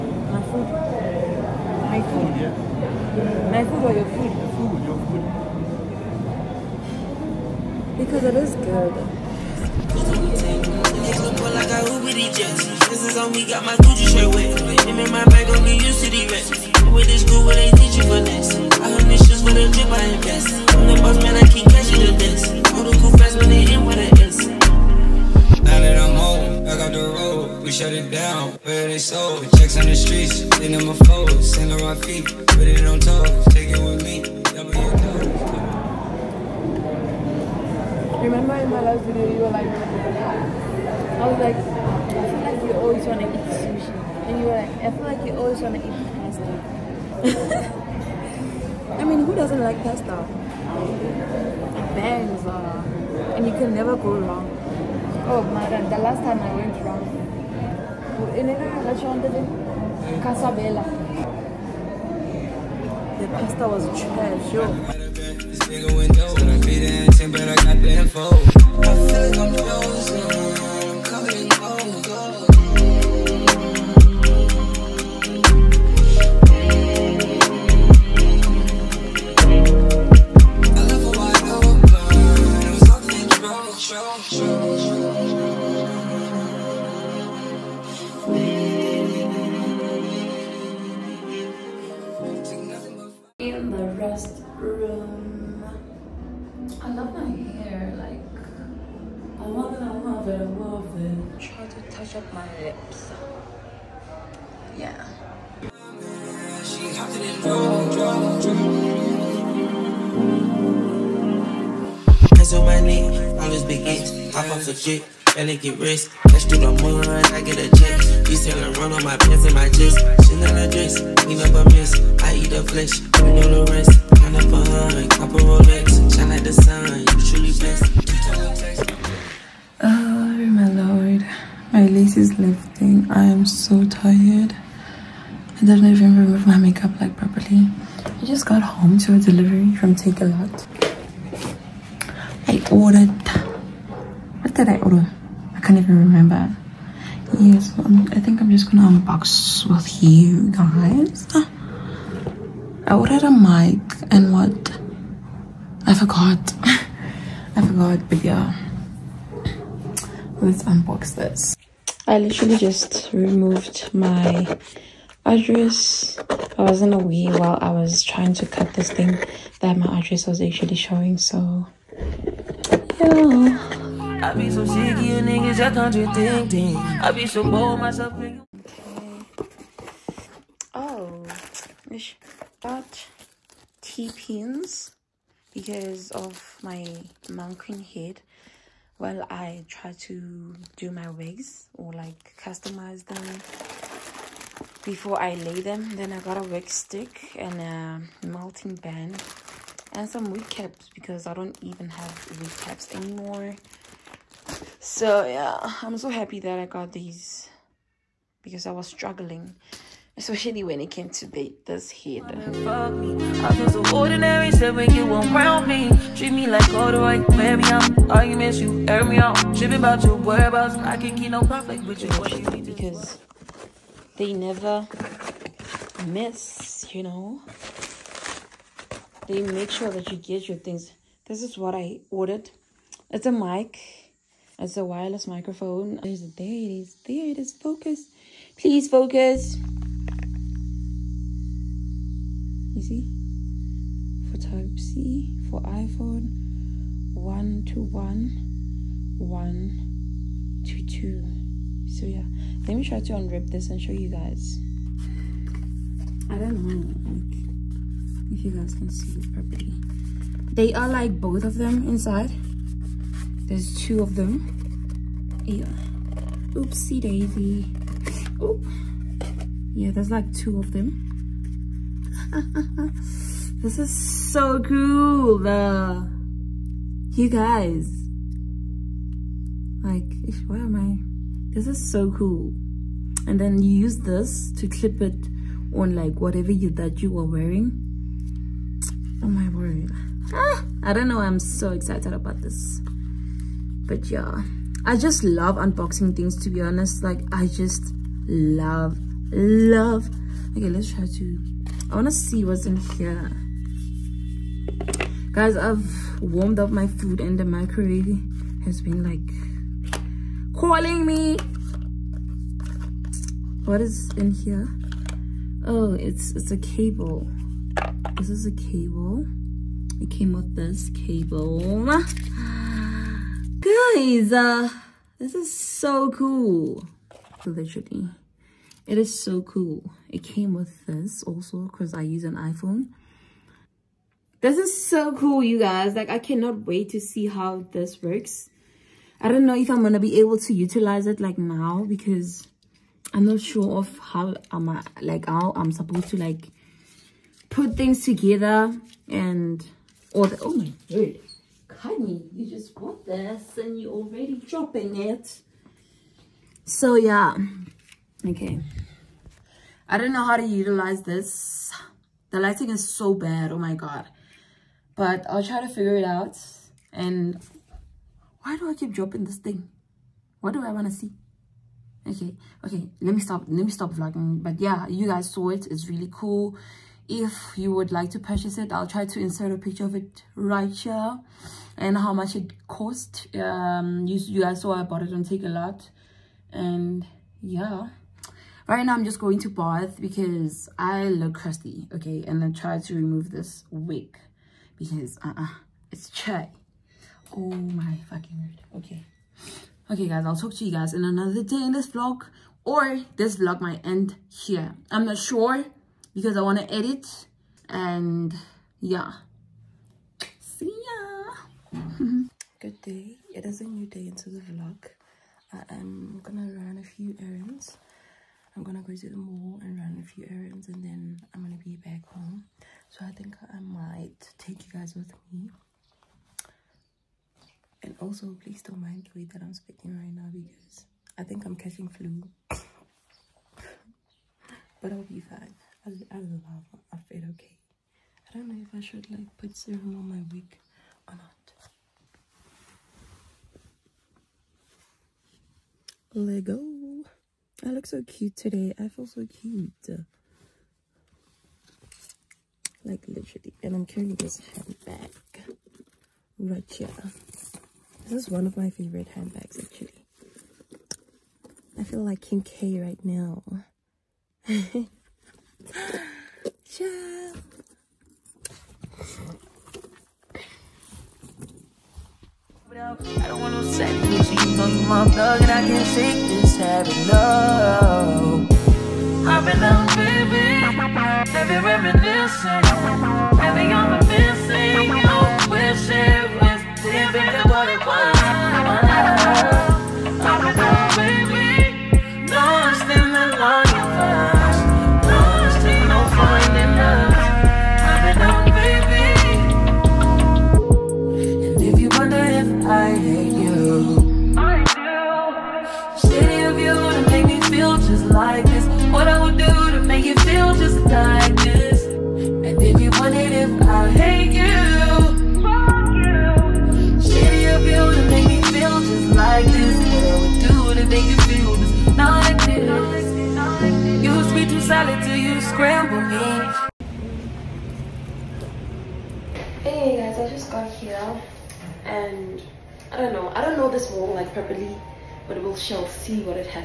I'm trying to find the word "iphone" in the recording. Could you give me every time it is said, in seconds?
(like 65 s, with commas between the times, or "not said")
245 s, 332 s.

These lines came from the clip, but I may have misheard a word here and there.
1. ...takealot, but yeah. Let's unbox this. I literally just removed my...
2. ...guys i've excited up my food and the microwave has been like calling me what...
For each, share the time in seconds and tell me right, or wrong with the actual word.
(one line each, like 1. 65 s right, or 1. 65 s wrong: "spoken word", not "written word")
1. 157 s wrong: "forgot", not "takealot"
2. 305 s wrong: "warmed", not "excited".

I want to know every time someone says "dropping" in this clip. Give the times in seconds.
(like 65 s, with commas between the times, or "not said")
354 s, 368 s.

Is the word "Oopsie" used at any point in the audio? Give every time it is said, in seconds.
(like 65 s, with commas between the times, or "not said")
266 s.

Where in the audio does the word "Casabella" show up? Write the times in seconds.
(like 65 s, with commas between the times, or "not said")
60 s.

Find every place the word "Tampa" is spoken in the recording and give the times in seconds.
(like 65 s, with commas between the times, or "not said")
not said.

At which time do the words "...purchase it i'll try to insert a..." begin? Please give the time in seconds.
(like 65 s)
378 s.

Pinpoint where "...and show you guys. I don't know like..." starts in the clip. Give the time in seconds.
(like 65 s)
253 s.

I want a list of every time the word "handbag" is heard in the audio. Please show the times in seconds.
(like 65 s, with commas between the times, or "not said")
454 s, 459 s.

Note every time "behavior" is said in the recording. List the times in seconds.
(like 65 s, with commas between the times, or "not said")
not said.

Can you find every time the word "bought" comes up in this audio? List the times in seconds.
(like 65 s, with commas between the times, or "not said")
352 s, 384 s.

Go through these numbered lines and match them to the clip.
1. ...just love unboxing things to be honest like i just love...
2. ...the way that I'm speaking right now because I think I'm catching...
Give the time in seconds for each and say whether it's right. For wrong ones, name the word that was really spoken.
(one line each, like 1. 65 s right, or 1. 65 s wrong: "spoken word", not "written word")
1. 294 s right
2. 429 s right.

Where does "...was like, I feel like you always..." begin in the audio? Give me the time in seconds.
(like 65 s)
41 s.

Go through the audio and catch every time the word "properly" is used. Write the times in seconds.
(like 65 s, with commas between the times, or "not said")
137 s, 259 s.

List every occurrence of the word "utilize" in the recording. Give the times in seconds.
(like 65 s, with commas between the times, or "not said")
340 s, 360 s.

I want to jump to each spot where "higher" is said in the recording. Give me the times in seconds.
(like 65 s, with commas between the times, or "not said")
not said.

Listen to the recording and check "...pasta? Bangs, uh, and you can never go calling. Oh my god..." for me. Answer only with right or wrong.
wrong.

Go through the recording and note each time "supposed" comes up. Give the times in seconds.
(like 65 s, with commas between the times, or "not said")
345 s.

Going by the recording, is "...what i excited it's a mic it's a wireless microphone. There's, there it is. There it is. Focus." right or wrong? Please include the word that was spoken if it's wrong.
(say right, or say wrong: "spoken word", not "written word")
wrong: "ordered", not "excited".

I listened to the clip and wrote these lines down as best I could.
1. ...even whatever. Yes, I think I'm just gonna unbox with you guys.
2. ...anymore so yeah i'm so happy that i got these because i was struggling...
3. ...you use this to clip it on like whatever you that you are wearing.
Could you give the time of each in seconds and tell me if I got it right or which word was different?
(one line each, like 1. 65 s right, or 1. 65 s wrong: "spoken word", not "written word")
1. 145 s wrong: "remember", not "whatever"
2. 202 s right
3. 283 s right.